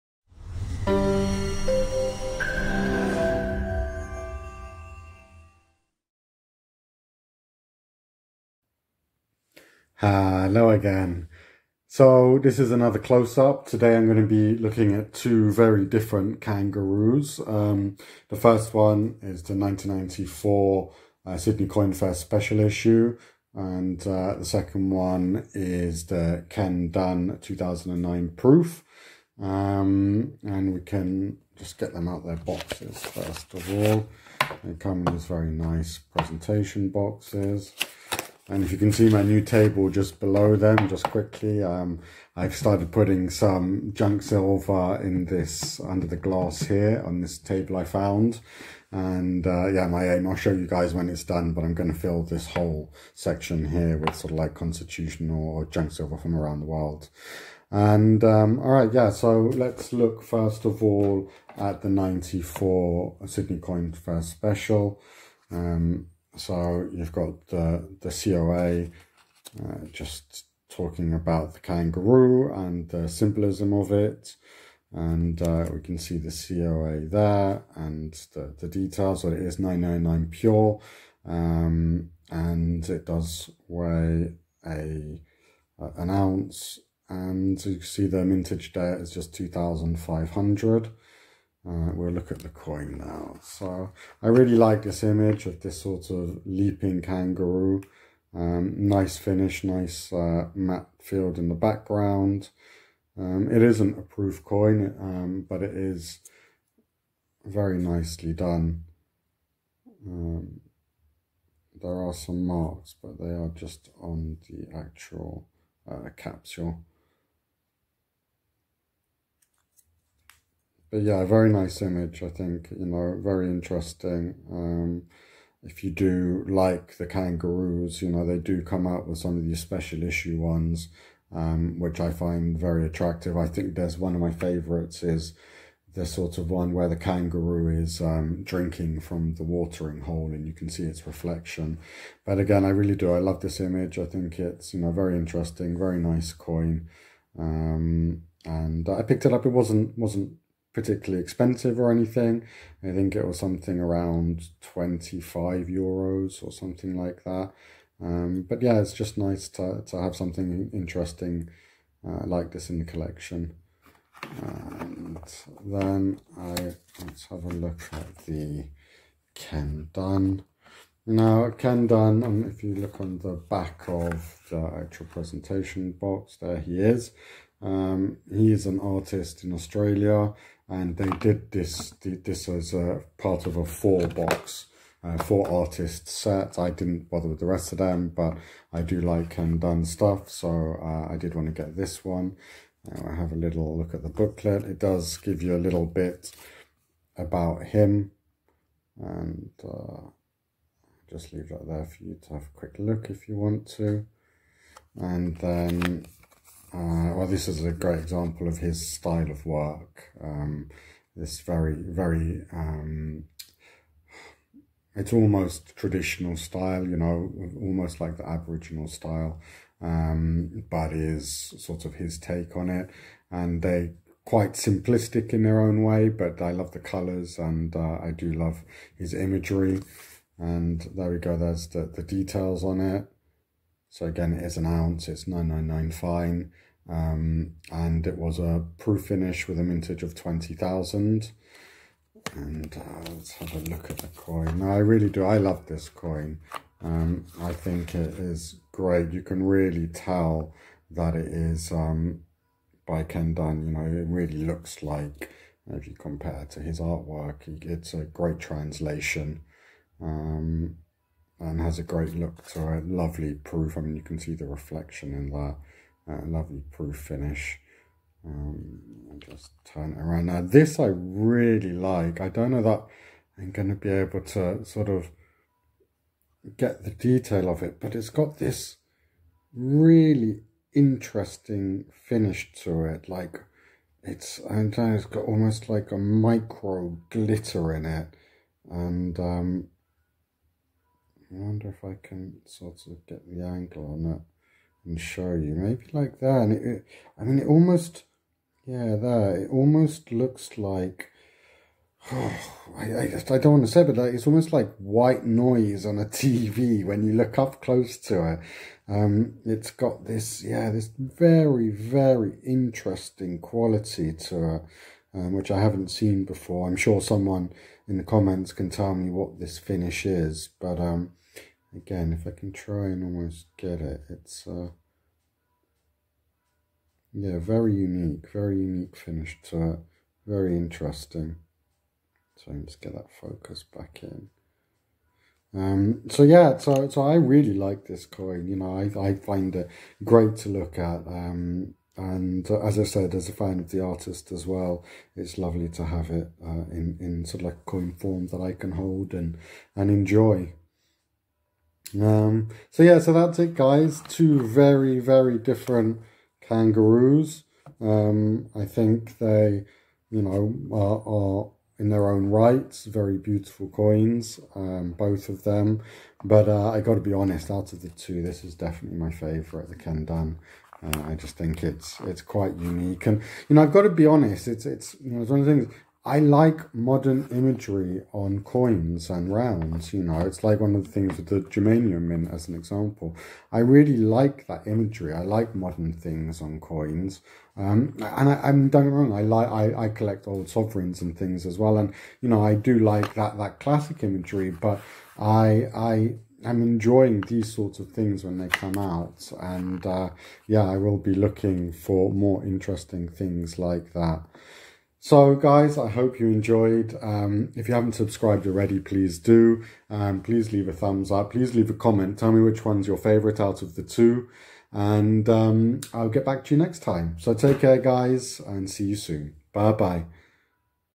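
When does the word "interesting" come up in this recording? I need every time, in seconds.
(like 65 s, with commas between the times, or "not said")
123 s, 145 s, 160 s, 280 s, 312 s, 330 s, 402 s.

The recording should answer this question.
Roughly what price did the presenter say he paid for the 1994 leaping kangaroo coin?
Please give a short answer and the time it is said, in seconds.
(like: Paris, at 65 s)
25 euros, at 154 s.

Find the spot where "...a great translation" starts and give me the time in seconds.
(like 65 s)
257 s.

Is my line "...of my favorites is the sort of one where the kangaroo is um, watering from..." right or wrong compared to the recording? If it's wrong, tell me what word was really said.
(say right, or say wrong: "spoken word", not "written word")
wrong: "drinking", not "watering".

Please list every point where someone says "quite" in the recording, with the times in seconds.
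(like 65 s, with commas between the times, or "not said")
224 s, 372 s.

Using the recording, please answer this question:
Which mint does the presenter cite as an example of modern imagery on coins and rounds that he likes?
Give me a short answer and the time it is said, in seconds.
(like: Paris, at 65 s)
Germania Mint, at 381 s.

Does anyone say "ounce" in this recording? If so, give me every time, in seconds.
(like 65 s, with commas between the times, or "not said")
86 s, 234 s.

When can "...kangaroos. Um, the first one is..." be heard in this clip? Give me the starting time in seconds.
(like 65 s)
16 s.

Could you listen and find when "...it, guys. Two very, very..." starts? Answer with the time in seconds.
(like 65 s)
353 s.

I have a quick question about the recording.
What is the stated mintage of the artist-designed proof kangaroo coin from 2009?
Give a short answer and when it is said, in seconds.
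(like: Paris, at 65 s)
20,000, at 240 s.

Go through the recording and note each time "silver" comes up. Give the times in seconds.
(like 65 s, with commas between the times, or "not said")
44 s, 55 s.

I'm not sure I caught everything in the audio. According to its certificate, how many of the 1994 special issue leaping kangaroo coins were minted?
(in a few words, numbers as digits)
2,500.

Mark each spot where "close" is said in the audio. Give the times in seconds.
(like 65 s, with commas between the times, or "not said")
12 s, 307 s.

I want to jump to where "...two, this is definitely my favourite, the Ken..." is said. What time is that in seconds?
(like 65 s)
367 s.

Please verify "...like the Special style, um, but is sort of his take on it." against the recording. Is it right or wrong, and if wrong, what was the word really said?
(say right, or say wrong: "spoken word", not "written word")
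wrong: "Aboriginal", not "Special".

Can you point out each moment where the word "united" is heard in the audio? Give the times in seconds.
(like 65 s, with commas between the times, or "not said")
not said.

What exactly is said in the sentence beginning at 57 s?
And um, all right, yeah, so let's look first of all at the 94 Sydney Coin Fair Special.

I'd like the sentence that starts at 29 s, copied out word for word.
Um, and we can just get them out their boxes first of all.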